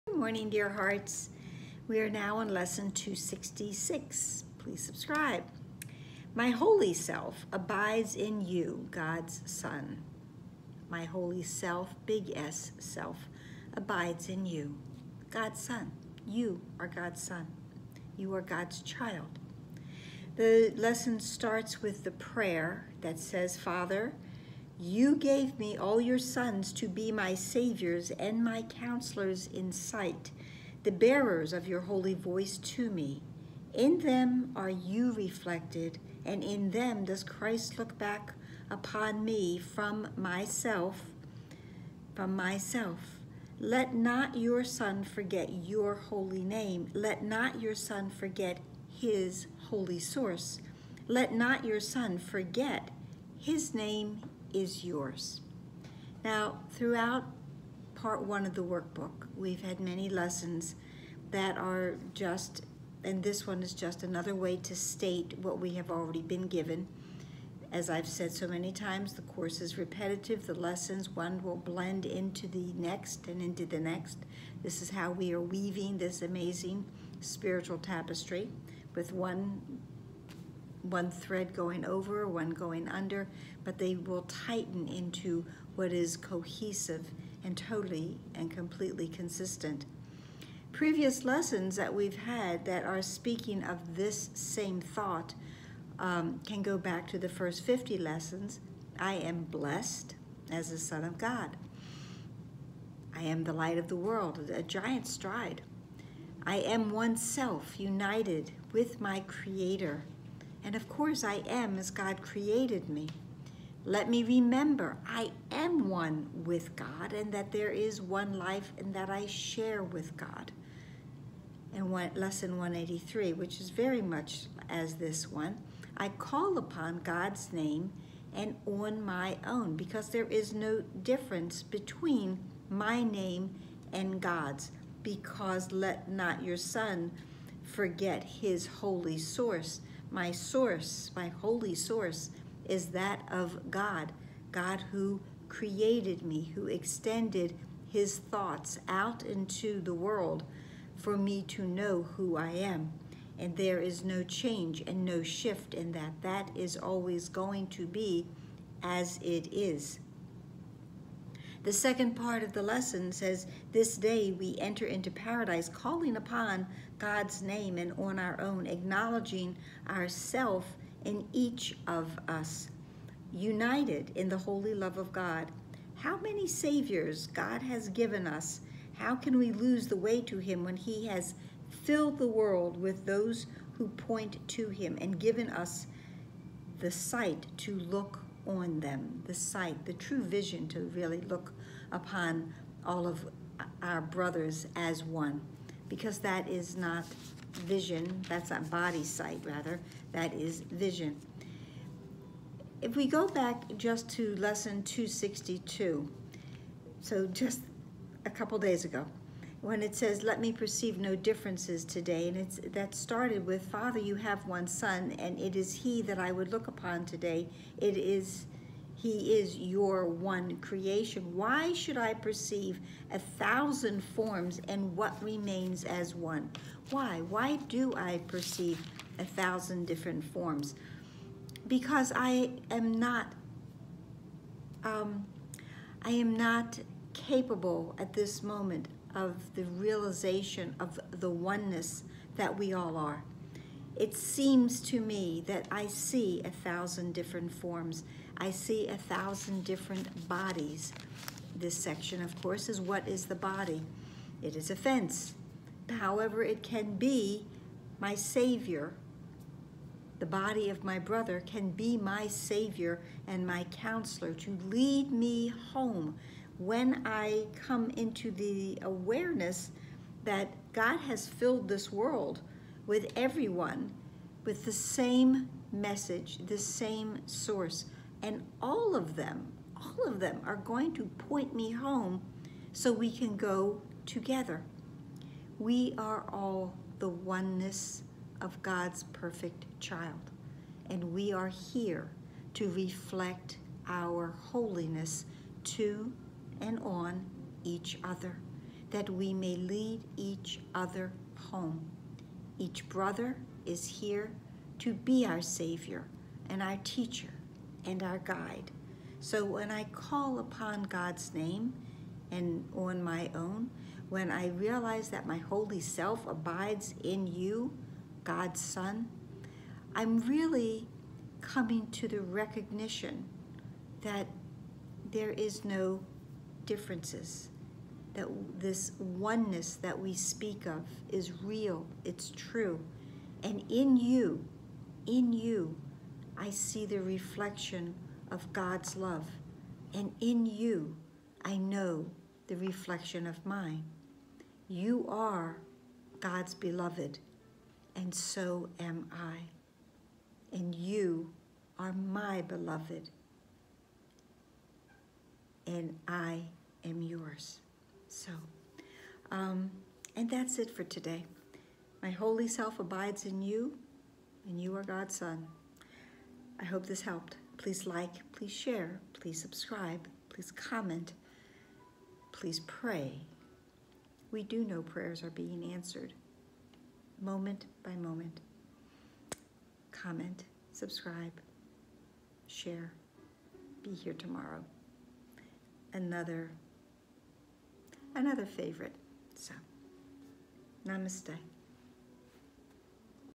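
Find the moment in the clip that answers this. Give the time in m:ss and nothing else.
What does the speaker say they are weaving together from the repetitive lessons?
1:17.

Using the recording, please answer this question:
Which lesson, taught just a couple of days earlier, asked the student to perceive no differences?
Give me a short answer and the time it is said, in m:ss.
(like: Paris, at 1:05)
262, at 3:24.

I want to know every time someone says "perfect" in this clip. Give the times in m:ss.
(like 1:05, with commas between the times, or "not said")
4:49.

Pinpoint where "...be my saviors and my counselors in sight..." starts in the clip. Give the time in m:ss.
0:26.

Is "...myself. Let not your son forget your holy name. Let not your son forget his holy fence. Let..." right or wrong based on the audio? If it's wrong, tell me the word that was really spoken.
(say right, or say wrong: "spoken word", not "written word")
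wrong: "source", not "fence".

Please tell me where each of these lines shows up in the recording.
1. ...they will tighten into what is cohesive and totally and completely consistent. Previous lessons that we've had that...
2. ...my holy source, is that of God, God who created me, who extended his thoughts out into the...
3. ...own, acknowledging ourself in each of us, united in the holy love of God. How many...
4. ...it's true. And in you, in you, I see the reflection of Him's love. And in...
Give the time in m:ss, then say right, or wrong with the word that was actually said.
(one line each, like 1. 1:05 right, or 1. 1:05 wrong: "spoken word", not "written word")
1. 1:23 right
2. 2:21 right
3. 2:48 right
4. 5:32 wrong: "God", not "Him".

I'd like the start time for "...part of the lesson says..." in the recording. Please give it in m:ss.
2:42.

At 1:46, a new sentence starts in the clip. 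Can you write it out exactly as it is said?
I am oneself, united with my creator.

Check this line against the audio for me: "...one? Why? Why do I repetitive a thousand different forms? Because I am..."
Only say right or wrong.
wrong.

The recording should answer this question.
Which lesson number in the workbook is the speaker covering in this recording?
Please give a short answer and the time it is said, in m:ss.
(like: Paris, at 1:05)
266, at 0:02.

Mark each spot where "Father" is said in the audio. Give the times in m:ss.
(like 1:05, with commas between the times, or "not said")
0:23, 3:33.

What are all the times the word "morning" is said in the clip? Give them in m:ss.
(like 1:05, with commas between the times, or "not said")
0:00.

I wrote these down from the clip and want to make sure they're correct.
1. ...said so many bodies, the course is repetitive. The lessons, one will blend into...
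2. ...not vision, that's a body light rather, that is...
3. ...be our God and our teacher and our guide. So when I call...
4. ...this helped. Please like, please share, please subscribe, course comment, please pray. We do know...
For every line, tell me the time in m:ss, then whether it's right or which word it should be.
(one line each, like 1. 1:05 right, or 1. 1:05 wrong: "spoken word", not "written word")
1. 1:08 wrong: "times", not "bodies"
2. 3:16 wrong: "sight", not "light"
3. 5:04 wrong: "Savior", not "God"
4. 6:06 wrong: "please", not "course".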